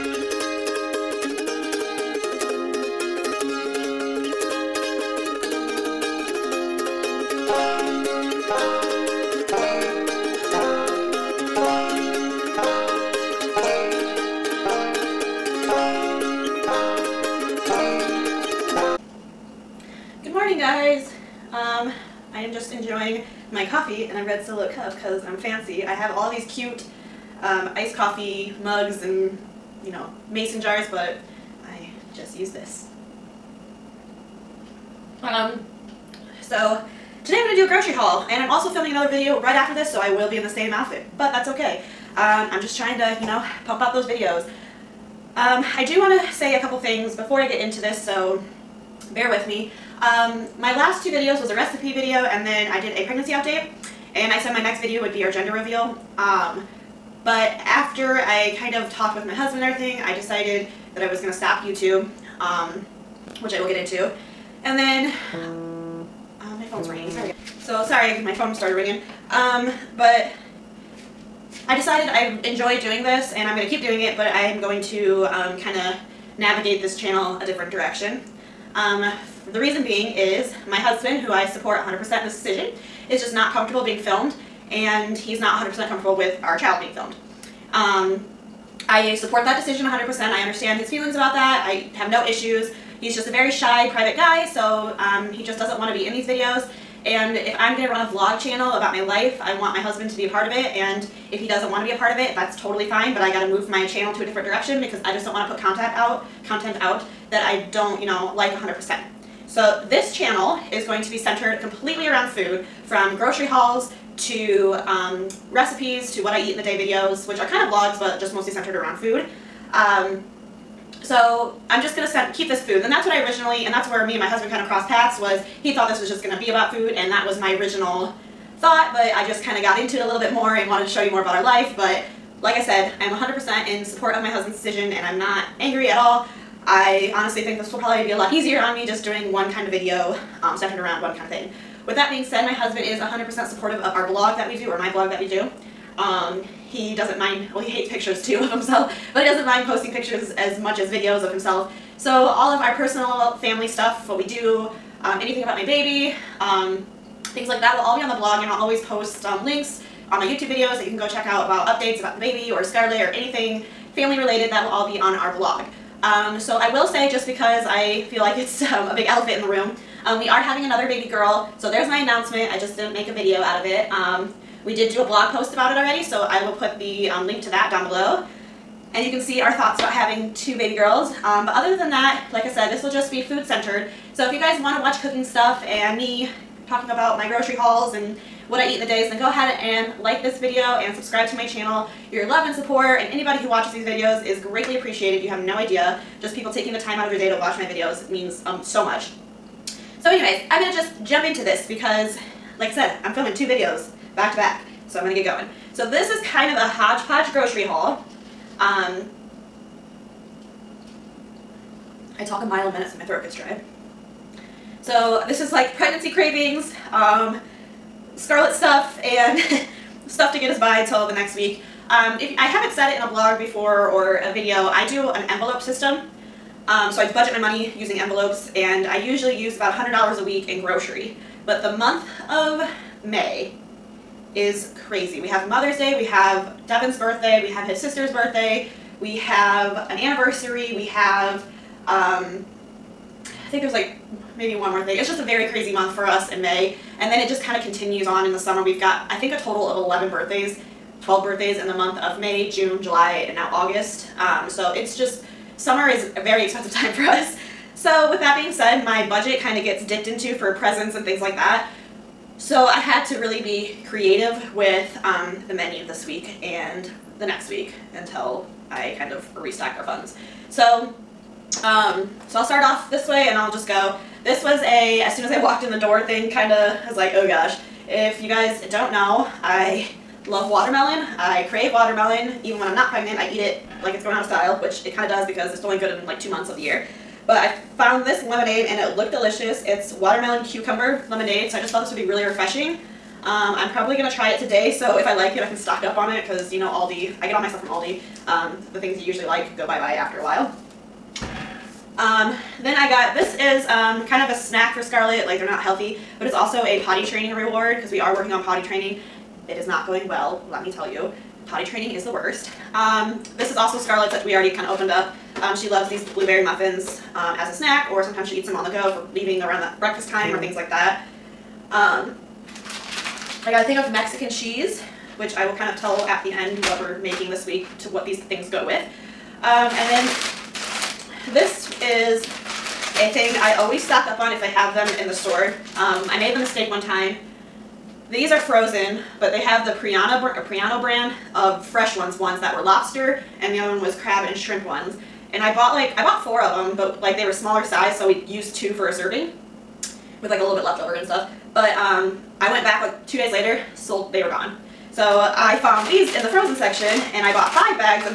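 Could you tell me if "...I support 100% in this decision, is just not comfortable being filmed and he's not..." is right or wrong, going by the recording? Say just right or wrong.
right.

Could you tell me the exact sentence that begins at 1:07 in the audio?
So sorry, my phone started ringing.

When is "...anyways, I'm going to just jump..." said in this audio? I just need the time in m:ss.
3:20.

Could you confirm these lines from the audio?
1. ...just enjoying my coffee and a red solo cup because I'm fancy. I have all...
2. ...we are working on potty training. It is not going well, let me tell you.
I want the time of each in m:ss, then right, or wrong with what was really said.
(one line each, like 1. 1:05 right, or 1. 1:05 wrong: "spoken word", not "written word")
1. 0:22 right
2. 5:07 right.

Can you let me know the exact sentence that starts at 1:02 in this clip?
Um, which I will get into.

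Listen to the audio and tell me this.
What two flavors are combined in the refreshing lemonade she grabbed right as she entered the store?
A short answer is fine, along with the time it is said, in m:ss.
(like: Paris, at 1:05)
Watermelon cucumber, at 4:49.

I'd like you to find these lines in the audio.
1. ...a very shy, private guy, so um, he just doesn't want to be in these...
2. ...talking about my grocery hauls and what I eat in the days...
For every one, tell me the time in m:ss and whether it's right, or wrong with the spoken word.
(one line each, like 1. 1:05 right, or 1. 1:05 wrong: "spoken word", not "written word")
1. 1:33 right
2. 3:06 right.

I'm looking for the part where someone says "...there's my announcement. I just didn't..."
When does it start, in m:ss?
2:51.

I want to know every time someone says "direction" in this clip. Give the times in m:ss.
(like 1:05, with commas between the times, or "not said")
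1:17, 1:44.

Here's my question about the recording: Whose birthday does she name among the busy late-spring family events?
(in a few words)
Devin.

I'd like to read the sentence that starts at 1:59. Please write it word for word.
Um, so I'm just gonna set, keep this food.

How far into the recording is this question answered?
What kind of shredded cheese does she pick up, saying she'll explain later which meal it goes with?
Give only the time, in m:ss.
5:23.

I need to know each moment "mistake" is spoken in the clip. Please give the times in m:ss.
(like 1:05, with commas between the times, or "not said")
5:36.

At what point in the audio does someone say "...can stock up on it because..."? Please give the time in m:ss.
4:55.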